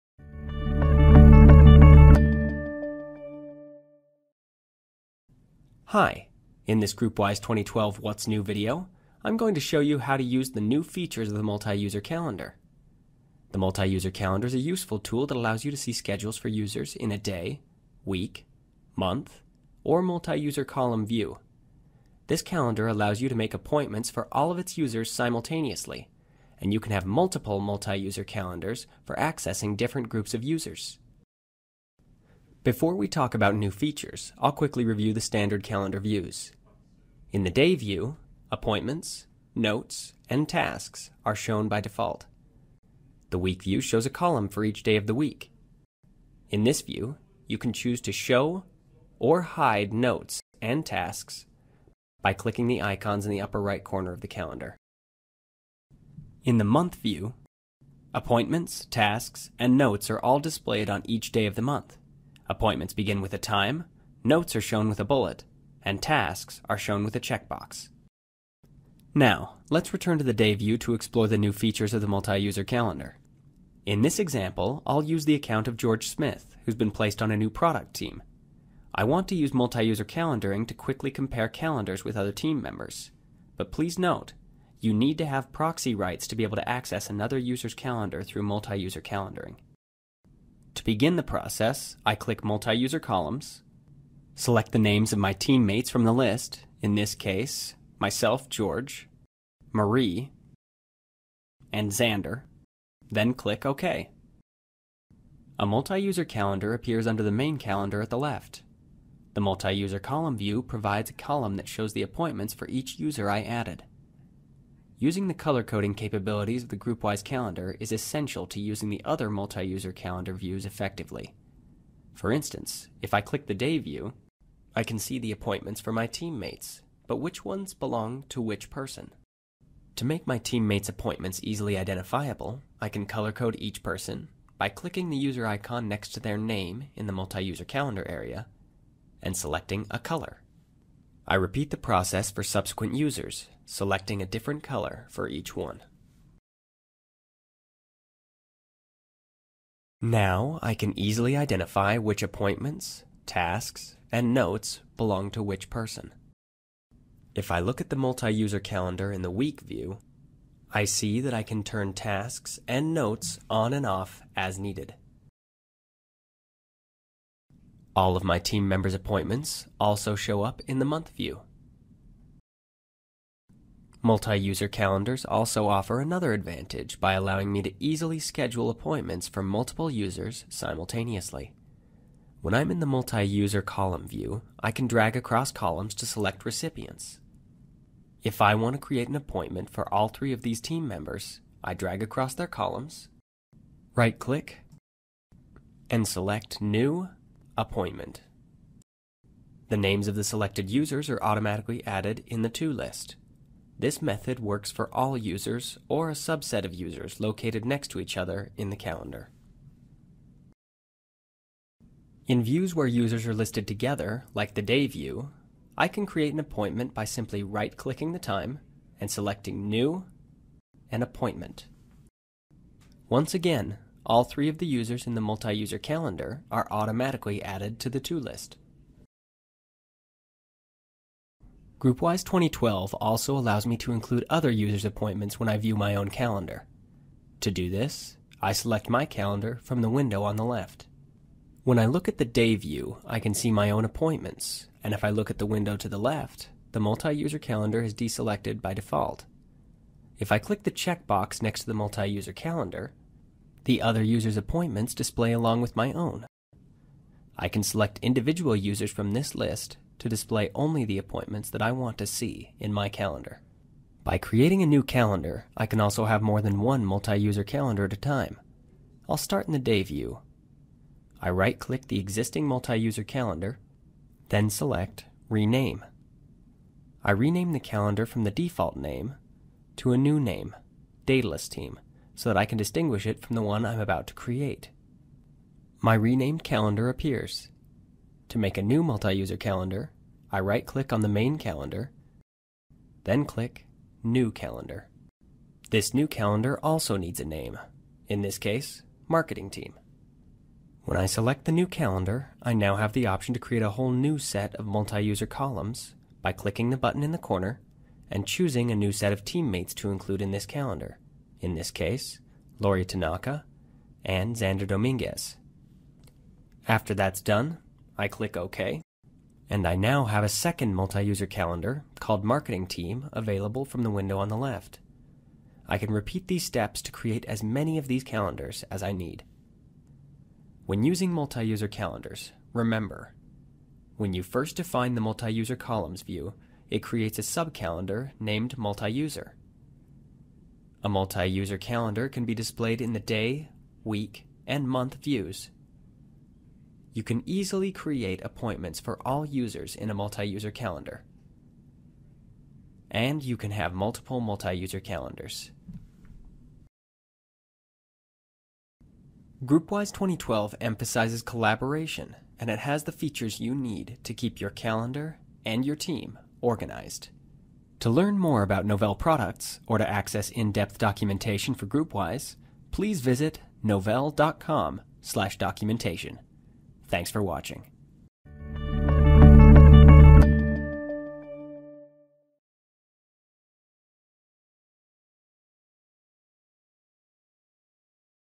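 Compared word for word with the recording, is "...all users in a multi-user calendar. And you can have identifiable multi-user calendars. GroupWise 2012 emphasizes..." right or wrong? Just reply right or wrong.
wrong.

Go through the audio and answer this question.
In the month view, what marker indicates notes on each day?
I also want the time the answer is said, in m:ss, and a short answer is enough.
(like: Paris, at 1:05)
A bullet, at 1:05.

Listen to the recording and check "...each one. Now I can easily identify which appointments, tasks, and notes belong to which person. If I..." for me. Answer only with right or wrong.
right.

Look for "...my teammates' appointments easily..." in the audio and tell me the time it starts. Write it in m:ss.
2:10.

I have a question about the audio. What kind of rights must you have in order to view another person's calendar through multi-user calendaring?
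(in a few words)
Proxy rights.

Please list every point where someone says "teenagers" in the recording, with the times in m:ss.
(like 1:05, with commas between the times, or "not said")
not said.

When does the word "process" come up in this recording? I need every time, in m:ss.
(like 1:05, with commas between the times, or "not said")
1:31, 2:21.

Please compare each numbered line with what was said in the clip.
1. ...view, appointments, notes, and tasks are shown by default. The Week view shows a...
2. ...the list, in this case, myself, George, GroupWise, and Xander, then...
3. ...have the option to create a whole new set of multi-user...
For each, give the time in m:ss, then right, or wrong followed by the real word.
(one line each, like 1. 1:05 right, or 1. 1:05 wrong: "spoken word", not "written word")
1. 0:37 right
2. 1:36 wrong: "Marie", not "GroupWise"
3. 5:02 right.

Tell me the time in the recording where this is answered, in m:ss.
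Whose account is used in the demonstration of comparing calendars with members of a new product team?
1:15.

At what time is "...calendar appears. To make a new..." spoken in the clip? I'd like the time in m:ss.
4:46.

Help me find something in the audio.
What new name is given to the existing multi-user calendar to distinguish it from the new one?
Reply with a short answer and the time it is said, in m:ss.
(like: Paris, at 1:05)
Datalist Team, at 4:41.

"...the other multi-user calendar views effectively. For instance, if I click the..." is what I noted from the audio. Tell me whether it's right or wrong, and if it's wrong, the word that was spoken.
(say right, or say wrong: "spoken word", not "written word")
right.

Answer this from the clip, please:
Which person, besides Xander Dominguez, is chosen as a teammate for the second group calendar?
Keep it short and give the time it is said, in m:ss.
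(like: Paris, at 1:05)
Lori Tanaka, at 5:12.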